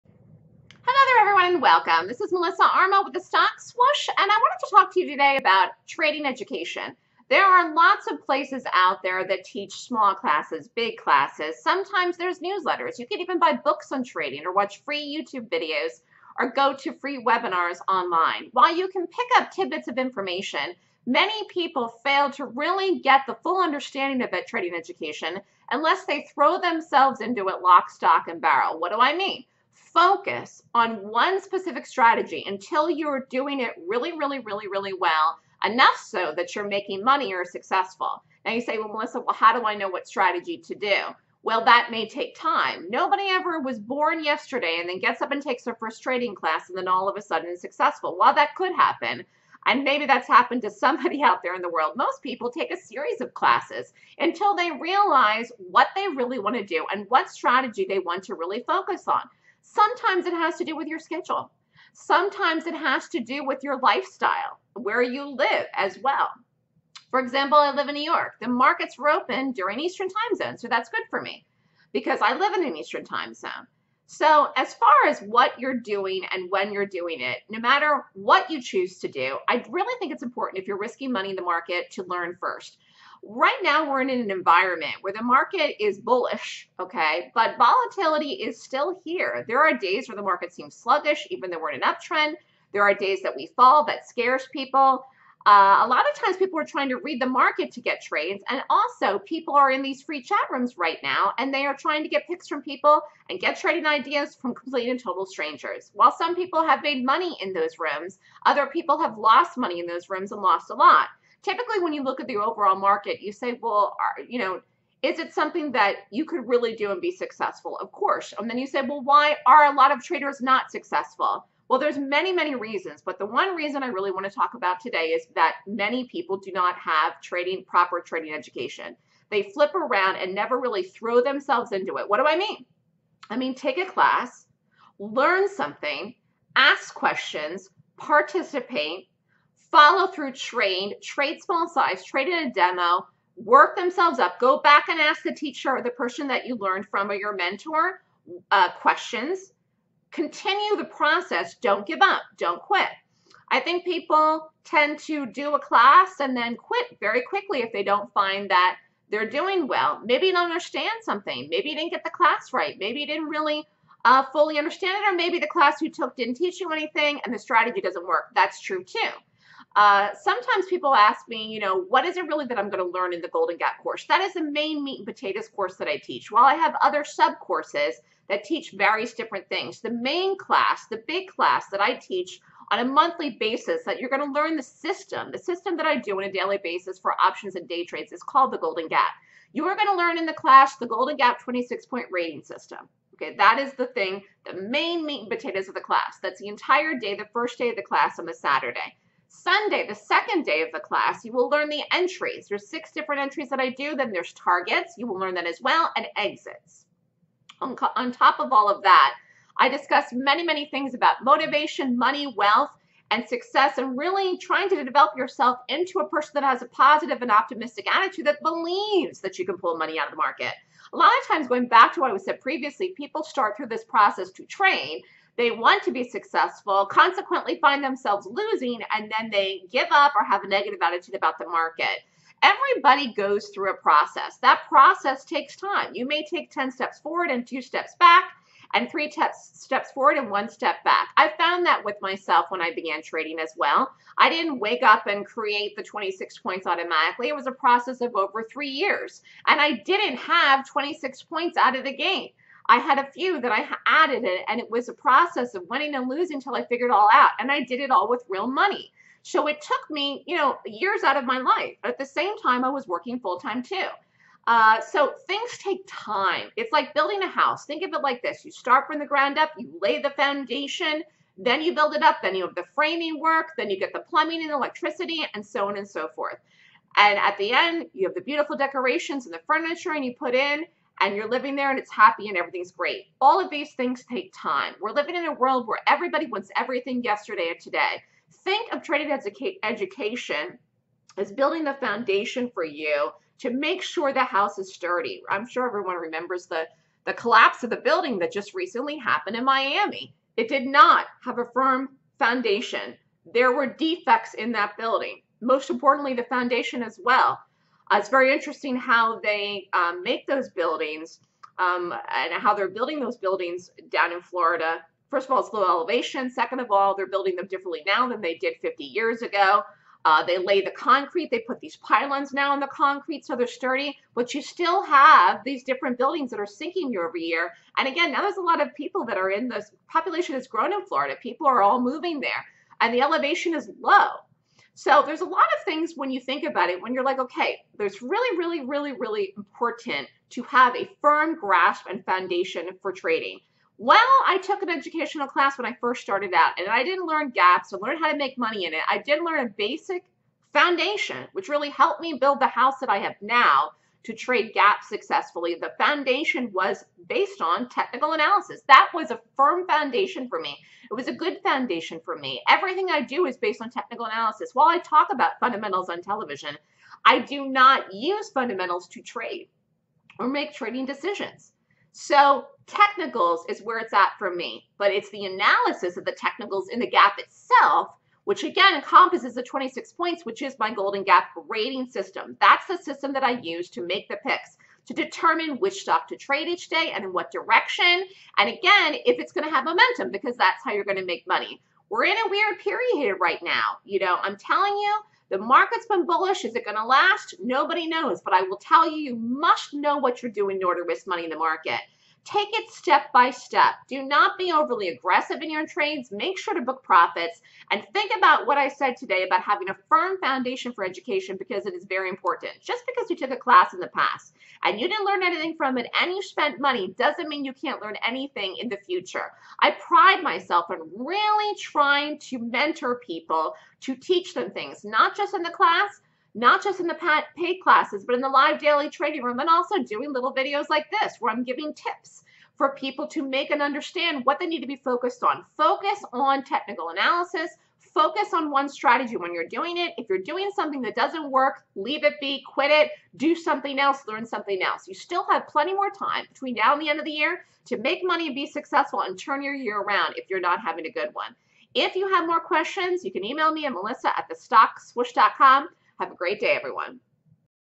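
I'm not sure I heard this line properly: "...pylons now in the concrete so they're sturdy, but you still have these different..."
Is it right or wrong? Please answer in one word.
right.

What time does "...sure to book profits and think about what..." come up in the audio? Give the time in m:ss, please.
6:46.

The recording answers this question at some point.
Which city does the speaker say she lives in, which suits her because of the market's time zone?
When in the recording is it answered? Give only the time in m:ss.
1:07.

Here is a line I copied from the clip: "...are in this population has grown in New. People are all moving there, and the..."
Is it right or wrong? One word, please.
wrong.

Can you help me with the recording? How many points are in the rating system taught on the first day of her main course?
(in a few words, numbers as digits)
26.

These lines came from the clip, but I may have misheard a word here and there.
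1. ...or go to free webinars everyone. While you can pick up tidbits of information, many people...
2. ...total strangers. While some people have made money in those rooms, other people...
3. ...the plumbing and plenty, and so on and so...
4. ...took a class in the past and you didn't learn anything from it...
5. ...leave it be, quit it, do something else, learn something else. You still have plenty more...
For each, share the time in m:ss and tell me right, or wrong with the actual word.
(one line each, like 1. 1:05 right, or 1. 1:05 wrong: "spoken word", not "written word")
1. 0:16 wrong: "online", not "everyone"
2. 1:44 right
3. 4:33 wrong: "electricity", not "plenty"
4. 6:53 right
5. 7:21 right.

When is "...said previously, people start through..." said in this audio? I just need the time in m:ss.
3:42.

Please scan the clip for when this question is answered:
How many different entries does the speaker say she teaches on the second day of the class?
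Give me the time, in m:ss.
3:22.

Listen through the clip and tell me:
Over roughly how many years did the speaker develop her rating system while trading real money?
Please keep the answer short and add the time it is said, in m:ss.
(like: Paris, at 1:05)
3 years, at 4:08.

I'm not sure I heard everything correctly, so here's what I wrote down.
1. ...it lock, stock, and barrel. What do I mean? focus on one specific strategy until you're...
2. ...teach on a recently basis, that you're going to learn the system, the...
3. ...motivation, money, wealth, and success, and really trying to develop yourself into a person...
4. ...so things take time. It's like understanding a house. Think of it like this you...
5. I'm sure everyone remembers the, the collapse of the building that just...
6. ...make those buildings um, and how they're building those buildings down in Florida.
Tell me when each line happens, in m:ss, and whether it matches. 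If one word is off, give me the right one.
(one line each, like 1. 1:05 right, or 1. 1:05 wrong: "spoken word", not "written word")
1. 0:27 right
2. 3:01 wrong: "monthly", not "recently"
3. 3:31 right
4. 4:24 wrong: "building", not "understanding"
5. 4:55 right
6. 5:10 right.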